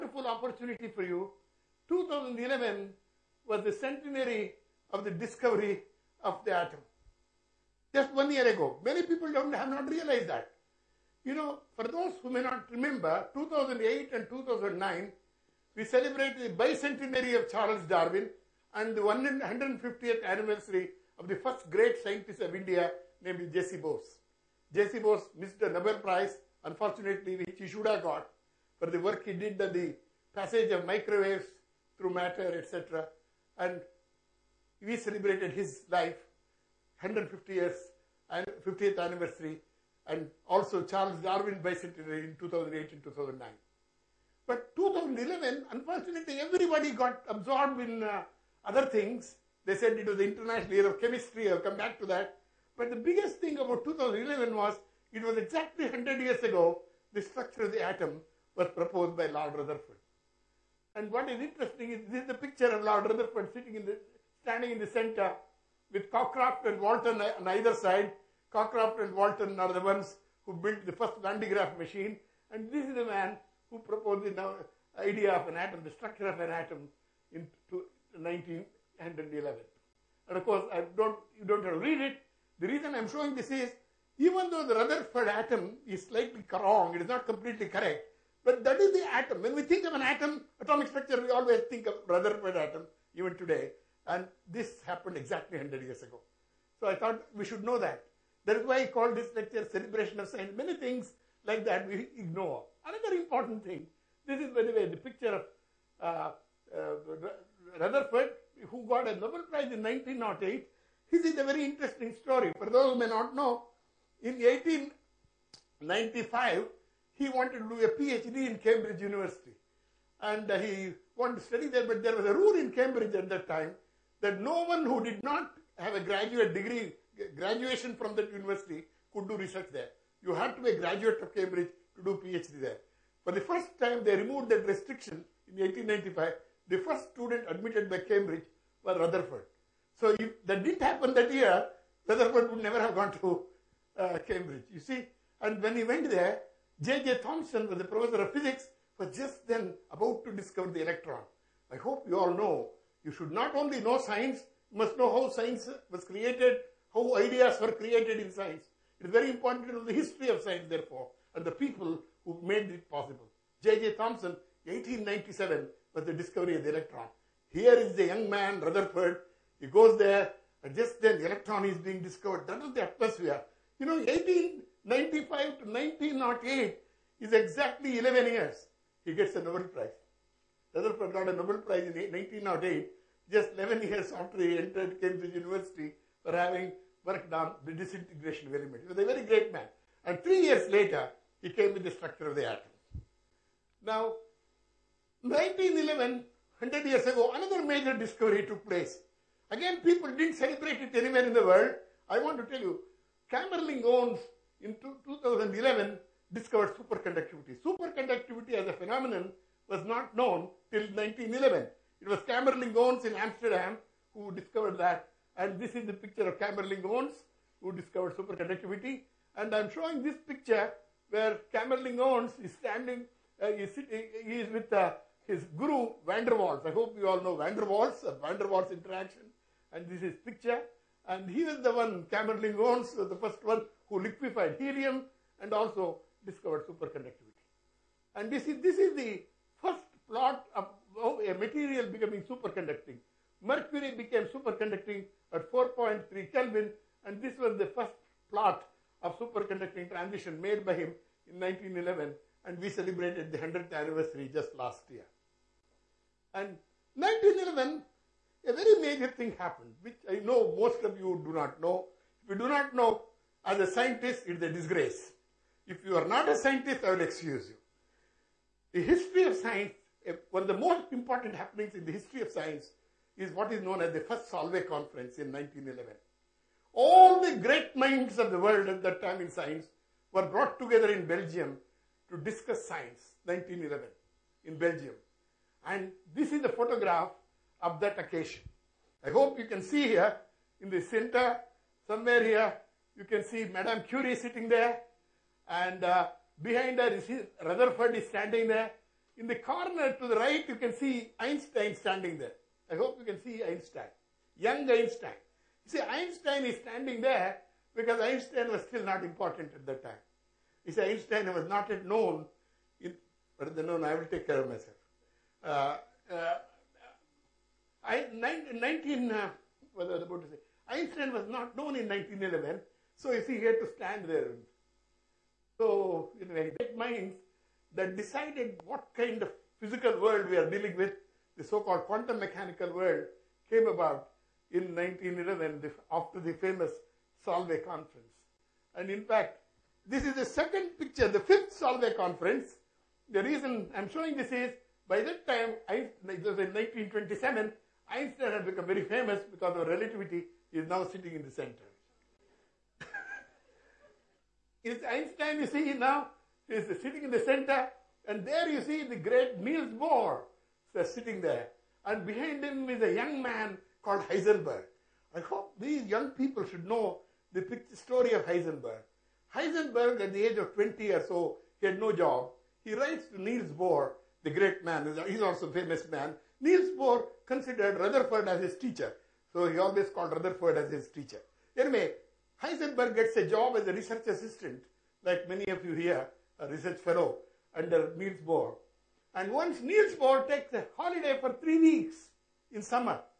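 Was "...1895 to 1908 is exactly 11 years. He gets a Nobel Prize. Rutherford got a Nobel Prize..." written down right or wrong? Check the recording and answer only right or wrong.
right.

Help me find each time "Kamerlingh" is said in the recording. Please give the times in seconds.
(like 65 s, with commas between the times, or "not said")
203 s, 212 s, 216 s, 221 s, 232 s.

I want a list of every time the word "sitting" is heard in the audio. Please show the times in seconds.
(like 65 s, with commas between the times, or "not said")
63 s, 294 s, 350 s, 356 s, 360 s.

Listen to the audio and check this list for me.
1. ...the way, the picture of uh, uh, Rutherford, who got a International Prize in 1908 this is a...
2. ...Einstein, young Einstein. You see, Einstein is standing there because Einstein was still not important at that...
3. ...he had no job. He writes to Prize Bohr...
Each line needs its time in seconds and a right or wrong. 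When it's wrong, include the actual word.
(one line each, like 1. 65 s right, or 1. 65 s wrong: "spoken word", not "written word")
1. 104 s wrong: "Nobel", not "International"
2. 303 s right
3. 371 s wrong: "Niels", not "Prize".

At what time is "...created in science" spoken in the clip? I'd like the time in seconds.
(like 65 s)
157 s.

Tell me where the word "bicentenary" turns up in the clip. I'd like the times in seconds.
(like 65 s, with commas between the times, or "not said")
16 s, 41 s.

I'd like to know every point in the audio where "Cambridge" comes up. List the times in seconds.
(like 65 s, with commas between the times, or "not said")
118 s, 122 s, 131 s, 137 s, 144 s, 185 s.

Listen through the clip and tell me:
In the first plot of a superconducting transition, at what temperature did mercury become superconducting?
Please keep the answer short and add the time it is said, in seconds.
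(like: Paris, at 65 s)
4.3 Kelvin, at 245 s.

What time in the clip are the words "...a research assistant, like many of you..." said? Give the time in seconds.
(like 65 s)
383 s.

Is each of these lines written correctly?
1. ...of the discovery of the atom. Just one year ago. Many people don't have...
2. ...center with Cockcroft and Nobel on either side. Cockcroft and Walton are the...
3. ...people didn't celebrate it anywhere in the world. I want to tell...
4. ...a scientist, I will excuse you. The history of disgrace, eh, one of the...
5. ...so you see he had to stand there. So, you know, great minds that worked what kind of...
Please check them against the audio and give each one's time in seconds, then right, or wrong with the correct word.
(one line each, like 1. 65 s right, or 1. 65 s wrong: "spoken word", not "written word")
1. 4 s right
2. 64 s wrong: "Walton", not "Nobel"
3. 199 s right
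4. 266 s wrong: "science", not "disgrace"
5. 322 s wrong: "decided", not "worked".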